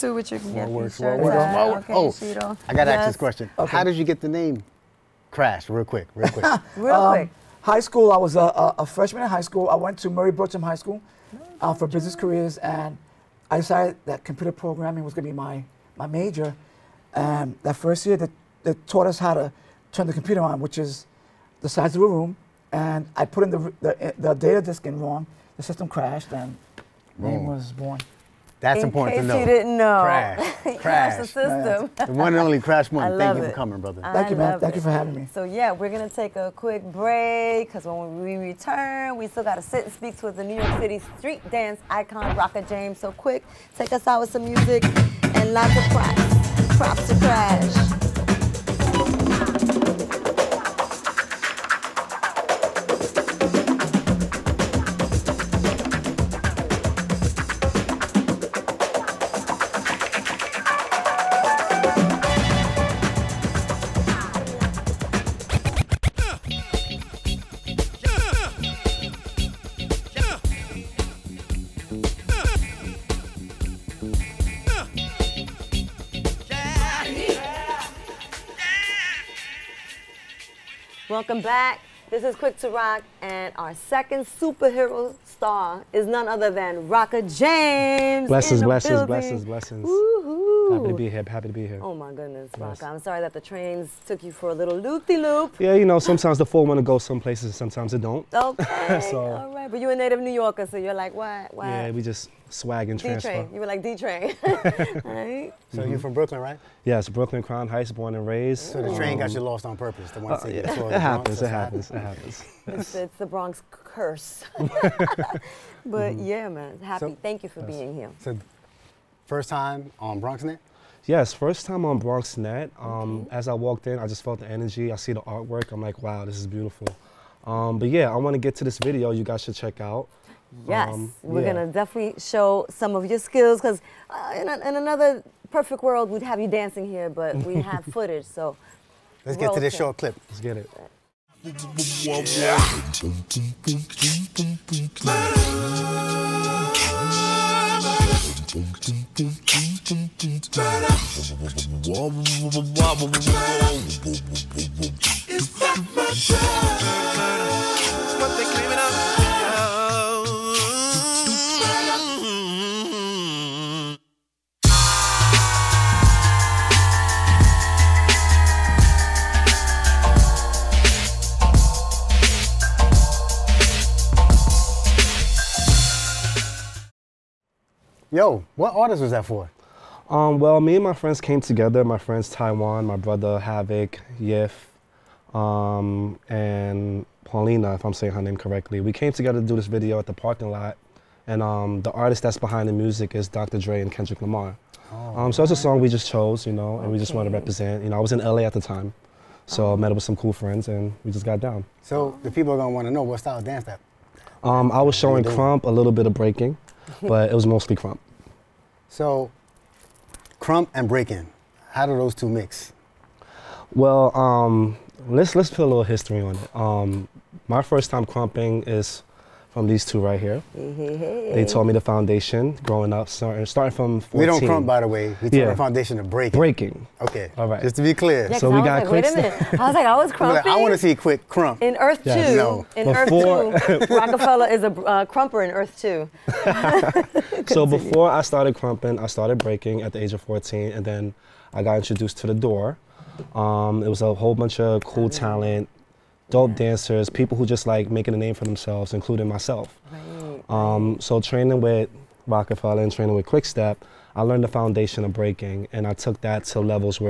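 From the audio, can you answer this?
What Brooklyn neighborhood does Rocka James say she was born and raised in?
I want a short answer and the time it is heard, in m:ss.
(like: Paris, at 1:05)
Crown Heights, at 1:47.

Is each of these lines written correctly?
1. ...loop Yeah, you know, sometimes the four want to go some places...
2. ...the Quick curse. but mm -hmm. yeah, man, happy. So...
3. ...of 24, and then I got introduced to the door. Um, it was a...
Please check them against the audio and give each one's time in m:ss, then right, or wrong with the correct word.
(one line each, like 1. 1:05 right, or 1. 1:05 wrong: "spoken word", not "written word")
1. 1:35 right
2. 1:53 wrong: "Bronx", not "Quick"
3. 4:00 wrong: "14", not "24".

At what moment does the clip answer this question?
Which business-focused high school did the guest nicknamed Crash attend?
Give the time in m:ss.
0:10.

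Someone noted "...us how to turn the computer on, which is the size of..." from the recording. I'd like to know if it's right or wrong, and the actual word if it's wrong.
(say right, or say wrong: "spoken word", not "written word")
right.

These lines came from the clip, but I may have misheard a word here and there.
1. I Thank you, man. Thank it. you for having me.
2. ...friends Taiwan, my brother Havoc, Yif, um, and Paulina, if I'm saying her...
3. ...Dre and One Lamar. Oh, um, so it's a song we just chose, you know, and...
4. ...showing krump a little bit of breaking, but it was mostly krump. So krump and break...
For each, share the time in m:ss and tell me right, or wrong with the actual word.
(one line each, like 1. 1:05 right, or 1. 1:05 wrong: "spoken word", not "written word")
1. 0:34 right
2. 3:01 right
3. 3:13 wrong: "Kendrick", not "One"
4. 3:24 right.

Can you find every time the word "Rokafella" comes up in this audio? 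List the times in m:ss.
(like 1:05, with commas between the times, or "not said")
3:53, 4:12.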